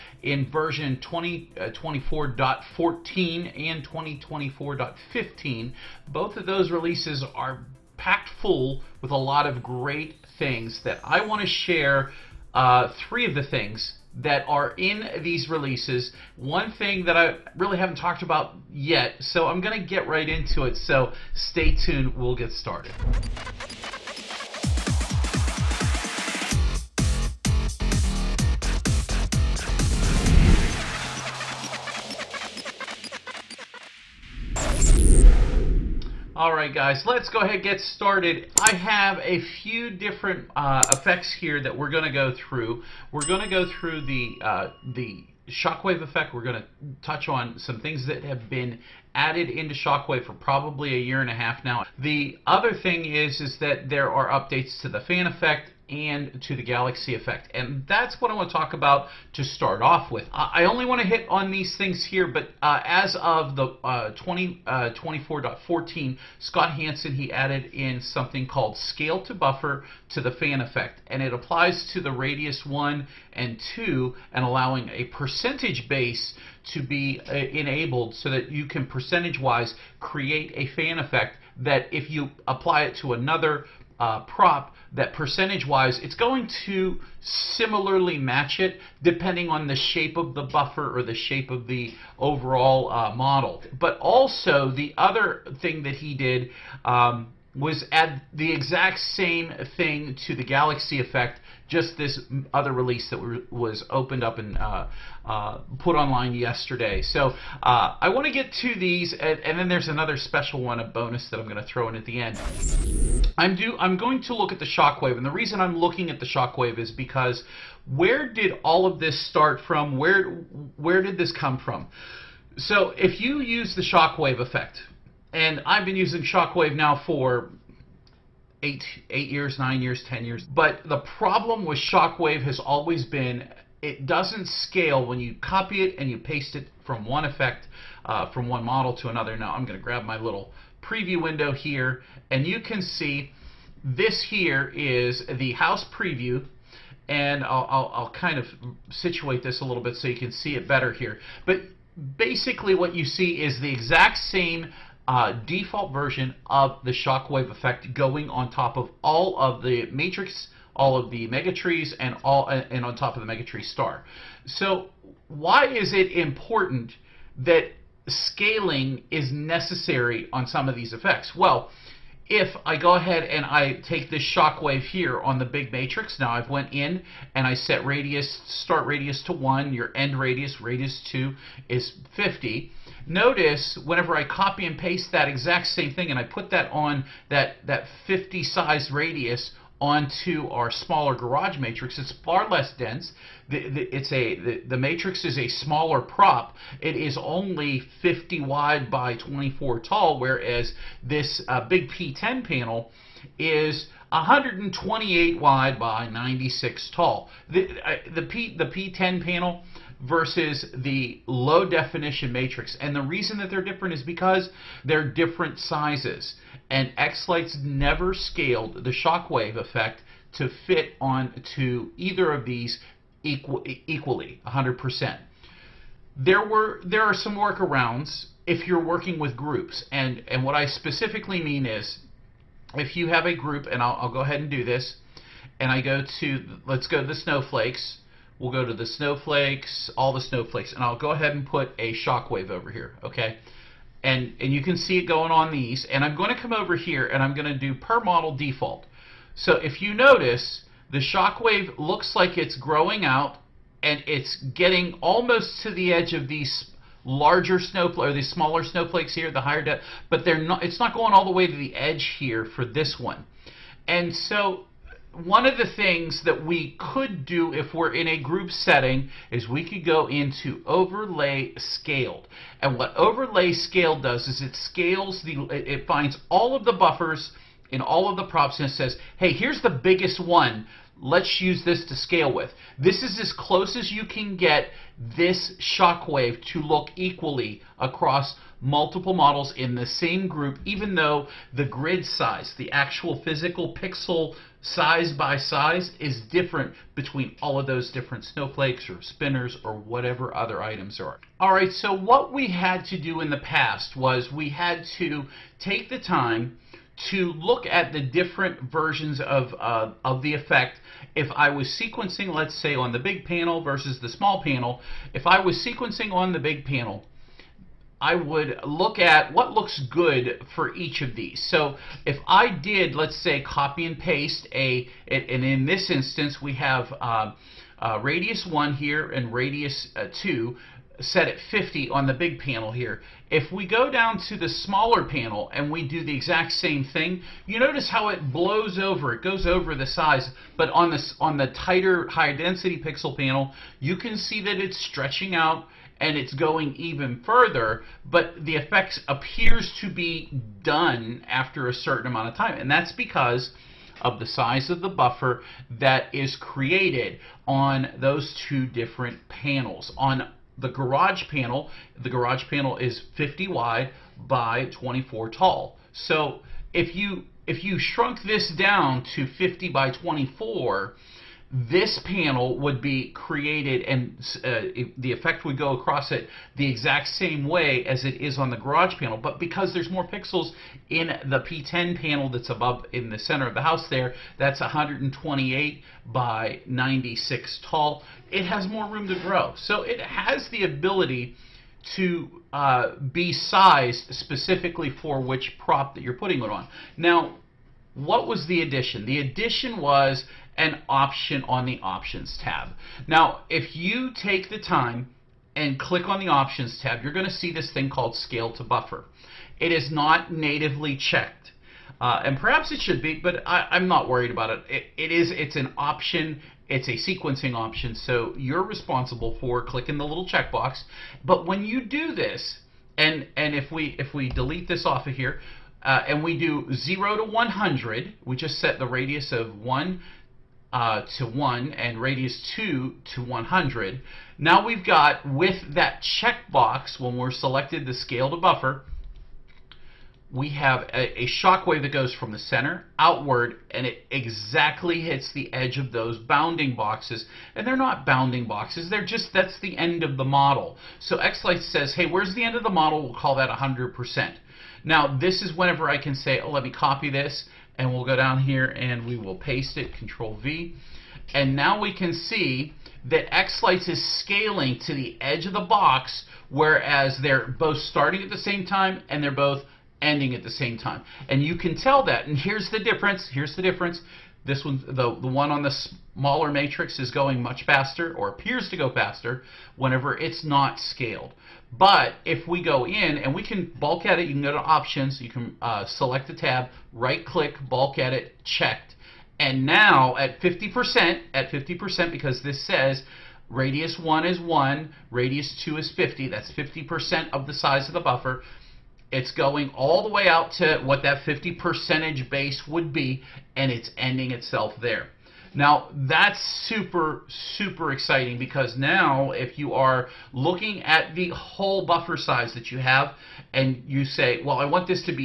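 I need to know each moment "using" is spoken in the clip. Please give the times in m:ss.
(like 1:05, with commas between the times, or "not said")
2:05.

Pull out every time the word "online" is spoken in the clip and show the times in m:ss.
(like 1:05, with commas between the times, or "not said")
1:45.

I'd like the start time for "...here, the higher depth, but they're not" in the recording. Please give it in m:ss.
4:19.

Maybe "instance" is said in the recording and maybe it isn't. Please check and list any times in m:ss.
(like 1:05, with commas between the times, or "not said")
5:25.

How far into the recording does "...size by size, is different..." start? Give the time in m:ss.
4:54.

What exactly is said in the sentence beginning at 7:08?
We just set the radius of 1 uh, to 1 and radius 2 to 100.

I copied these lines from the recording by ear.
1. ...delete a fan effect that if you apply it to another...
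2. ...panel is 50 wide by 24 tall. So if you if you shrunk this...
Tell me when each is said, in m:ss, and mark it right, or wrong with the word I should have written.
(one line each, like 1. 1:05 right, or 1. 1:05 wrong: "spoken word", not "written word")
1. 1:19 wrong: "create", not "delete"
2. 6:02 right.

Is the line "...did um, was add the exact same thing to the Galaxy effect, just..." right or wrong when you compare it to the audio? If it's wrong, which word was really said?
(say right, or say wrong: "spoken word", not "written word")
right.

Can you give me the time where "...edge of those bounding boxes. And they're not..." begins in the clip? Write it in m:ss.
7:25.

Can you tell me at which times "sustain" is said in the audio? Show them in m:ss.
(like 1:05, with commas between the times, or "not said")
not said.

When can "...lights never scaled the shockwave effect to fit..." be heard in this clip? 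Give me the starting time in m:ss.
3:37.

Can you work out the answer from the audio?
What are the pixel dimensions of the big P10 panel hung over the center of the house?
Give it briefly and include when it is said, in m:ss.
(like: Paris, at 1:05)
128 by 96, at 3:24.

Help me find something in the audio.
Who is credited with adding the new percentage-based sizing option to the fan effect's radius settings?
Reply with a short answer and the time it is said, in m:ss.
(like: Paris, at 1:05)
Scott Hansen, at 1:06.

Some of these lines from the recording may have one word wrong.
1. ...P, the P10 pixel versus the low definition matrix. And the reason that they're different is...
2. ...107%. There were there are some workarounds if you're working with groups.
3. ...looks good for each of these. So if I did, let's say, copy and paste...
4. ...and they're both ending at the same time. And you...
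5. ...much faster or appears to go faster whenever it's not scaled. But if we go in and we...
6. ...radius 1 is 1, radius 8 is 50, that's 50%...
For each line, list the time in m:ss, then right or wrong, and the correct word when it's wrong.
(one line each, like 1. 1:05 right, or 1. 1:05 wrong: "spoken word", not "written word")
1. 3:28 wrong: "panel", not "pixel"
2. 3:44 wrong: "100", not "107"
3. 5:19 right
4. 7:49 right
5. 7:57 right
6. 8:13 wrong: "2", not "8".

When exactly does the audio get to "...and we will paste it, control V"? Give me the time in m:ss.
7:38.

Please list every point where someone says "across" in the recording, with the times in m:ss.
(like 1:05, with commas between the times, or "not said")
4:47, 6:15.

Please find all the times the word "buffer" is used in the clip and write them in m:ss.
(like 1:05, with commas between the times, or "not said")
1:09, 1:30, 4:36, 5:54, 6:48, 7:18, 8:18, 8:31.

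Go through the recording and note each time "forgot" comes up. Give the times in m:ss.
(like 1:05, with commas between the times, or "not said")
not said.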